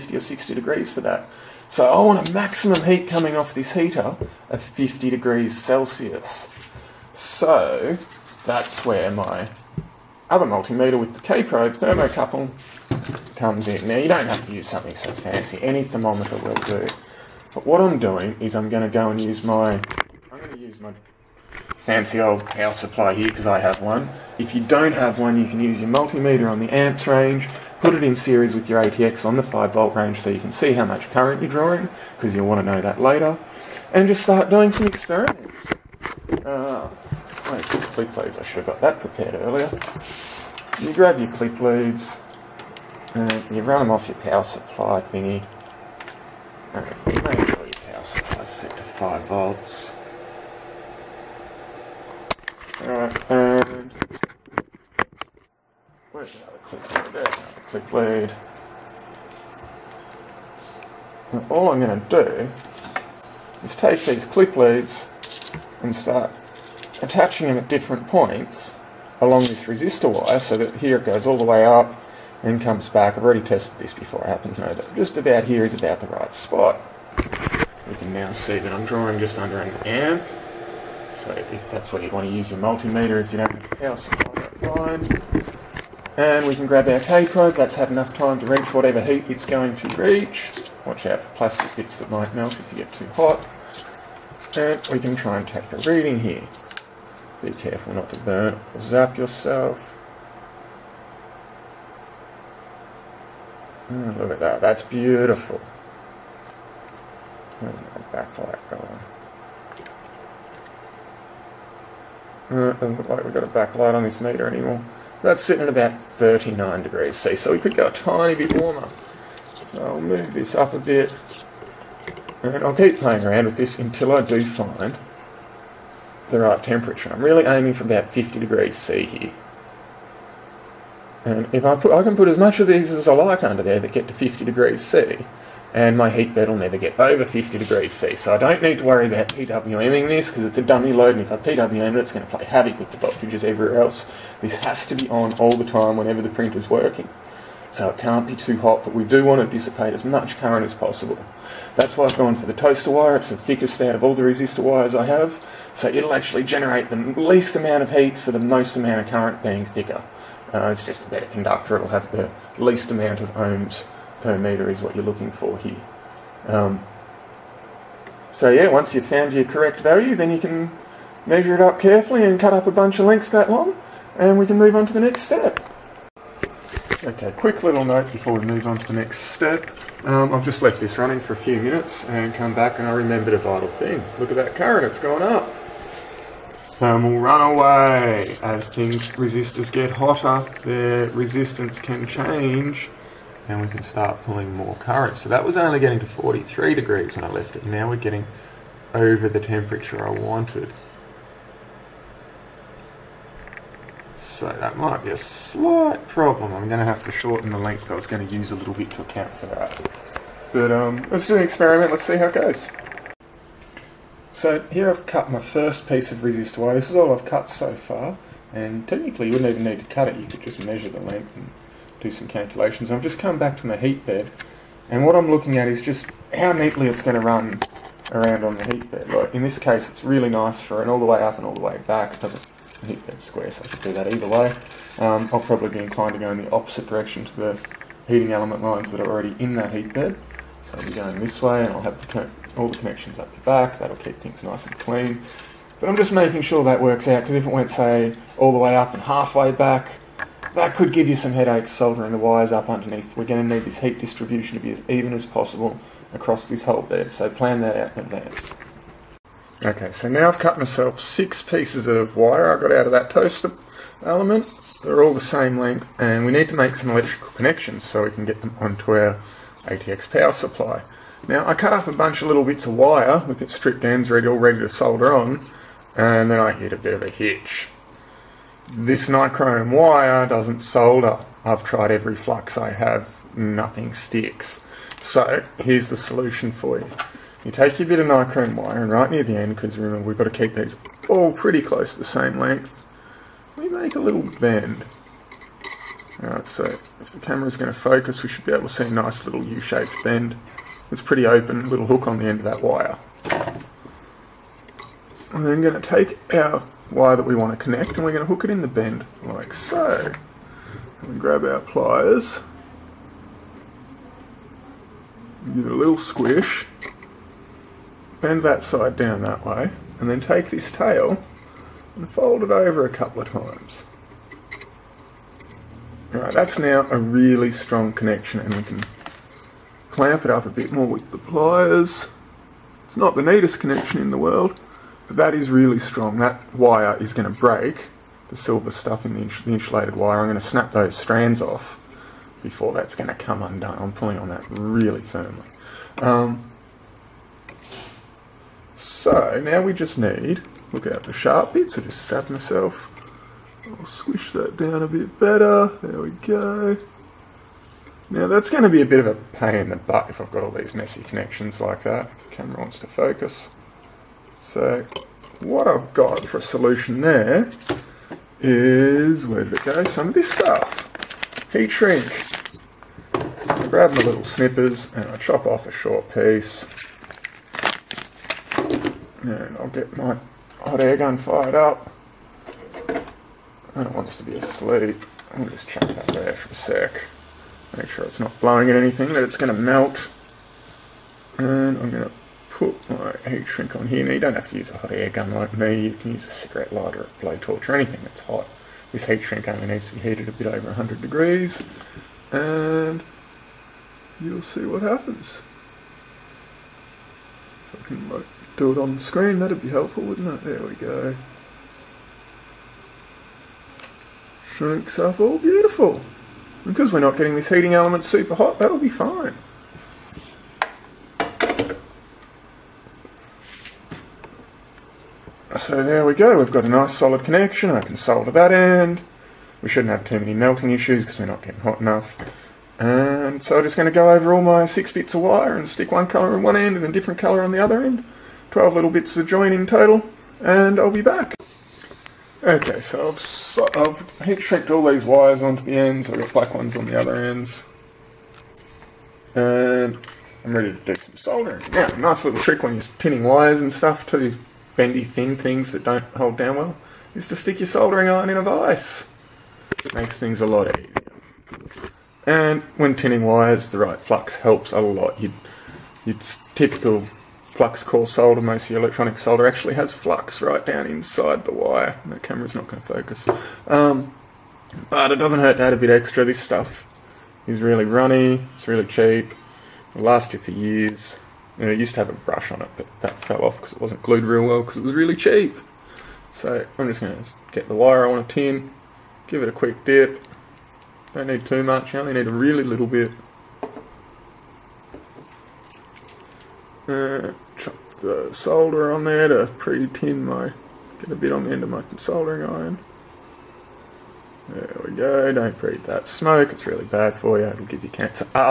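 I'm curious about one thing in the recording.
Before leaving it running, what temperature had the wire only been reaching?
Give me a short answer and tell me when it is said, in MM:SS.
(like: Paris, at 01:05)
43 degrees, at 03:16.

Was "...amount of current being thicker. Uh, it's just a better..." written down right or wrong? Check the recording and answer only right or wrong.
right.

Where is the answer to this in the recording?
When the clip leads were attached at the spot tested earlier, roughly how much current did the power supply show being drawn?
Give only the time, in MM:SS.
01:19.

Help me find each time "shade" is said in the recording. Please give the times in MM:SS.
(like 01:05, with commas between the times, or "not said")
not said.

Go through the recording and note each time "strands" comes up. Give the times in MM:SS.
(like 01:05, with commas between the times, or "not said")
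05:40.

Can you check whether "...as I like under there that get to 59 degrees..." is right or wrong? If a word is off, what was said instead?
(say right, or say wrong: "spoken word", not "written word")
wrong: "50", not "59".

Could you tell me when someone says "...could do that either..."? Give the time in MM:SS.
03:53.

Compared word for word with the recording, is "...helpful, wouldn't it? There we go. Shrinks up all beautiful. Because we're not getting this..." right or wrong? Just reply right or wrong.
right.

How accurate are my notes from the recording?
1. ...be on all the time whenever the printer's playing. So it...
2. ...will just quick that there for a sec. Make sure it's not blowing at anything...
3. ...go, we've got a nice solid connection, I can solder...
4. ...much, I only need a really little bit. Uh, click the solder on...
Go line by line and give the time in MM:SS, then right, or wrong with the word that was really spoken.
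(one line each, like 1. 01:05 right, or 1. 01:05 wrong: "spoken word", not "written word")
1. 02:24 wrong: "working", not "playing"
2. 06:25 wrong: "chuck", not "quick"
3. 07:06 right
4. 08:11 wrong: "chuck", not "click".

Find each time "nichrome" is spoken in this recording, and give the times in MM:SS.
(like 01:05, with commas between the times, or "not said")
04:39, 04:48.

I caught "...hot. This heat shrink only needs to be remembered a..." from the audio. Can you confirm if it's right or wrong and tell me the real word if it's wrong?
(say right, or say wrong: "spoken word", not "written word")
wrong: "heated", not "remembered".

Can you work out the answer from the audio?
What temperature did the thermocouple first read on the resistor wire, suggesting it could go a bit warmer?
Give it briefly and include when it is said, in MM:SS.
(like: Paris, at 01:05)
39 degrees C, at 01:55.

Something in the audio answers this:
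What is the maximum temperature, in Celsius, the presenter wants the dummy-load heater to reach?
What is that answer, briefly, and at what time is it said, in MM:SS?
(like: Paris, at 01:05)
50 degrees Celsius, at 00:04.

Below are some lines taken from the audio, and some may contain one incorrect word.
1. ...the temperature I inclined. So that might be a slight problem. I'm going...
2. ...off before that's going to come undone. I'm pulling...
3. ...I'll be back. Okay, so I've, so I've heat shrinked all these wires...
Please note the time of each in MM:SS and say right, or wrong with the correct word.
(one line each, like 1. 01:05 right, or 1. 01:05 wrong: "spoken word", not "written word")
1. 03:19 wrong: "wanted", not "inclined"
2. 05:41 right
3. 07:20 right.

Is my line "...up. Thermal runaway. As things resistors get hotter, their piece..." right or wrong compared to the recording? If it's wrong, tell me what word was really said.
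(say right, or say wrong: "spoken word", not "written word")
wrong: "resistance", not "piece".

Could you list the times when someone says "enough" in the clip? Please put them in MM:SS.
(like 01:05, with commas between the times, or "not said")
01:27, 07:11.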